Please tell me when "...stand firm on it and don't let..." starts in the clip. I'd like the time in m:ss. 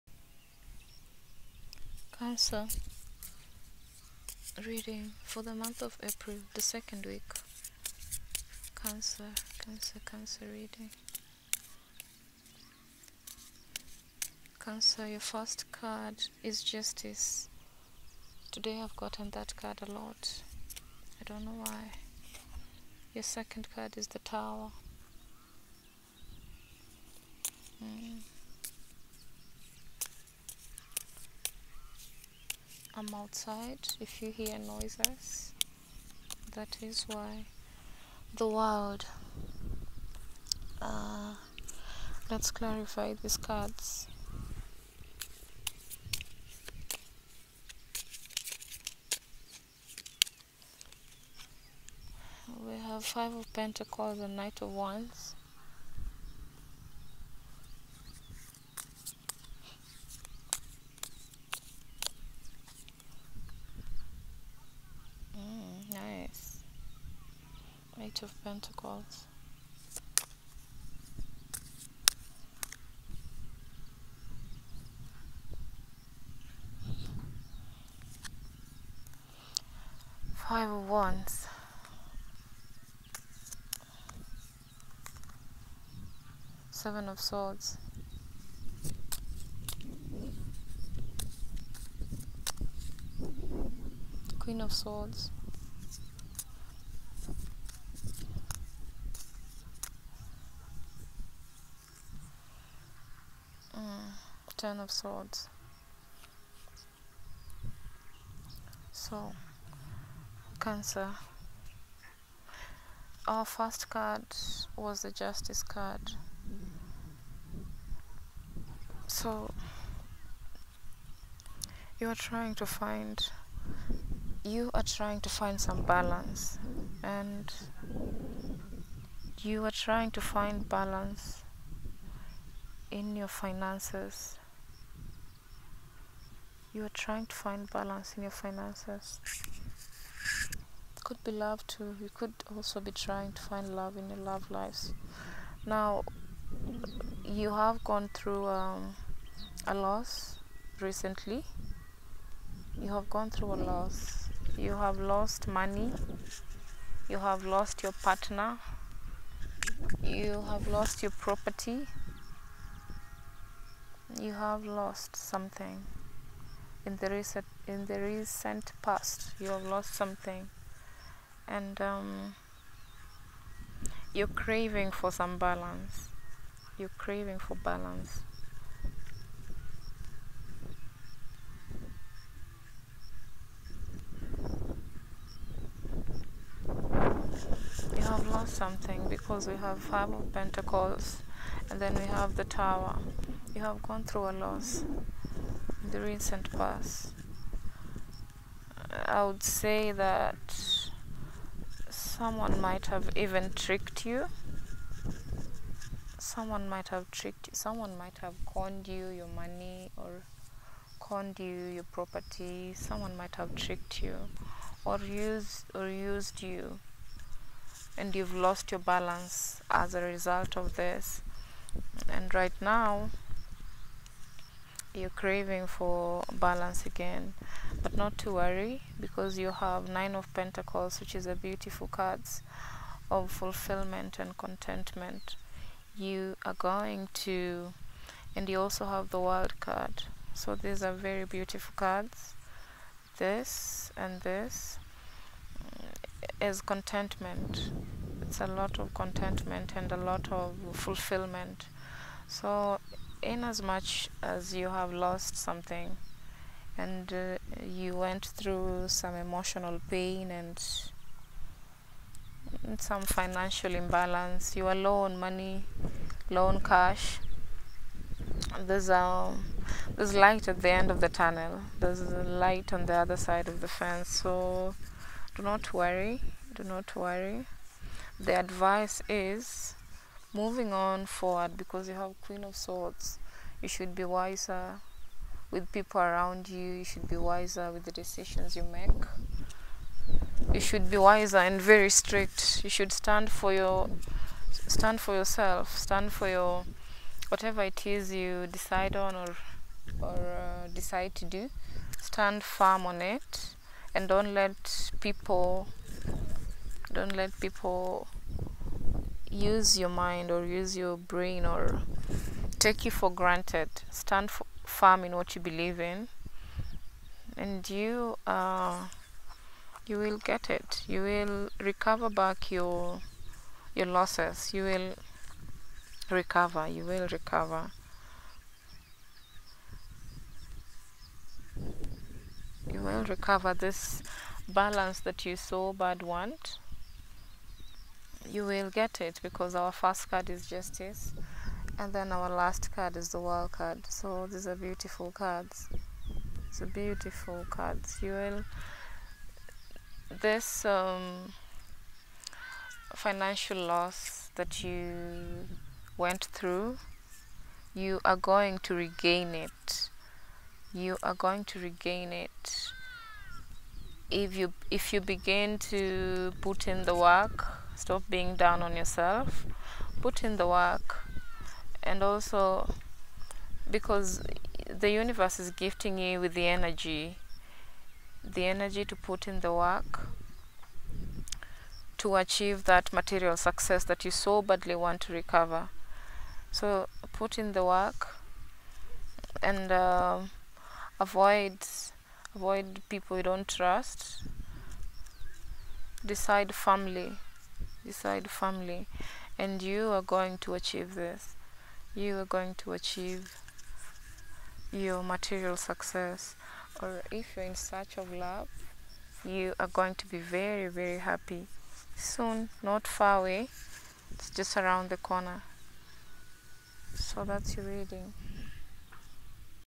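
5:02.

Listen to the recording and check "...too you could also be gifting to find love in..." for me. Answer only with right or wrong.
wrong.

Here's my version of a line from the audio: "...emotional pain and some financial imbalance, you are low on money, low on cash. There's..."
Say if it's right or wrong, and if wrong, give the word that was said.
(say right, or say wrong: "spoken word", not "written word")
right.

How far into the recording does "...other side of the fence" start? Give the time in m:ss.
4:32.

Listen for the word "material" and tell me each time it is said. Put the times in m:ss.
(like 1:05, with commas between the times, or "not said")
6:22, 6:45.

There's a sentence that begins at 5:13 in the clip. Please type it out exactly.
Stand firm in what you believe in, and you uh, you will get it.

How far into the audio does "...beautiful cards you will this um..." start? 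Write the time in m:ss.
5:46.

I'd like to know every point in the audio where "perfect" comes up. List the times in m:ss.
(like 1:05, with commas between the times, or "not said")
not said.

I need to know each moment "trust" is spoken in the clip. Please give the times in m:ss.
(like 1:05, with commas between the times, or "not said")
6:33.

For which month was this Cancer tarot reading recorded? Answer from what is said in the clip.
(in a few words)
April.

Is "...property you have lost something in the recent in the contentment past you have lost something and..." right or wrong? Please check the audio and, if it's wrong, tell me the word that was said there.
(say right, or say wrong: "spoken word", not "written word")
wrong: "recent", not "contentment".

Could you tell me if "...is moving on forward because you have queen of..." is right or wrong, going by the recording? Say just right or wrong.
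right.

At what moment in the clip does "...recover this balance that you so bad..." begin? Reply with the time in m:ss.
5:33.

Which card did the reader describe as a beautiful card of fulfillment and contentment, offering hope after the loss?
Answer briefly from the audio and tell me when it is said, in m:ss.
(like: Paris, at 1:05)
Nine of Pentacles, at 3:49.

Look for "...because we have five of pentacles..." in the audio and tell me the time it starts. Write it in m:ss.
3:09.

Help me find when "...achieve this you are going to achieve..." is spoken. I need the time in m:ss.
6:40.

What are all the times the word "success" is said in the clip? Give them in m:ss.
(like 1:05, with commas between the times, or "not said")
6:23, 6:45.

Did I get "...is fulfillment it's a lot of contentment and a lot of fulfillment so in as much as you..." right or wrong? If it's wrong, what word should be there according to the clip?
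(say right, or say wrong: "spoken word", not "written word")
wrong: "contentment", not "fulfillment".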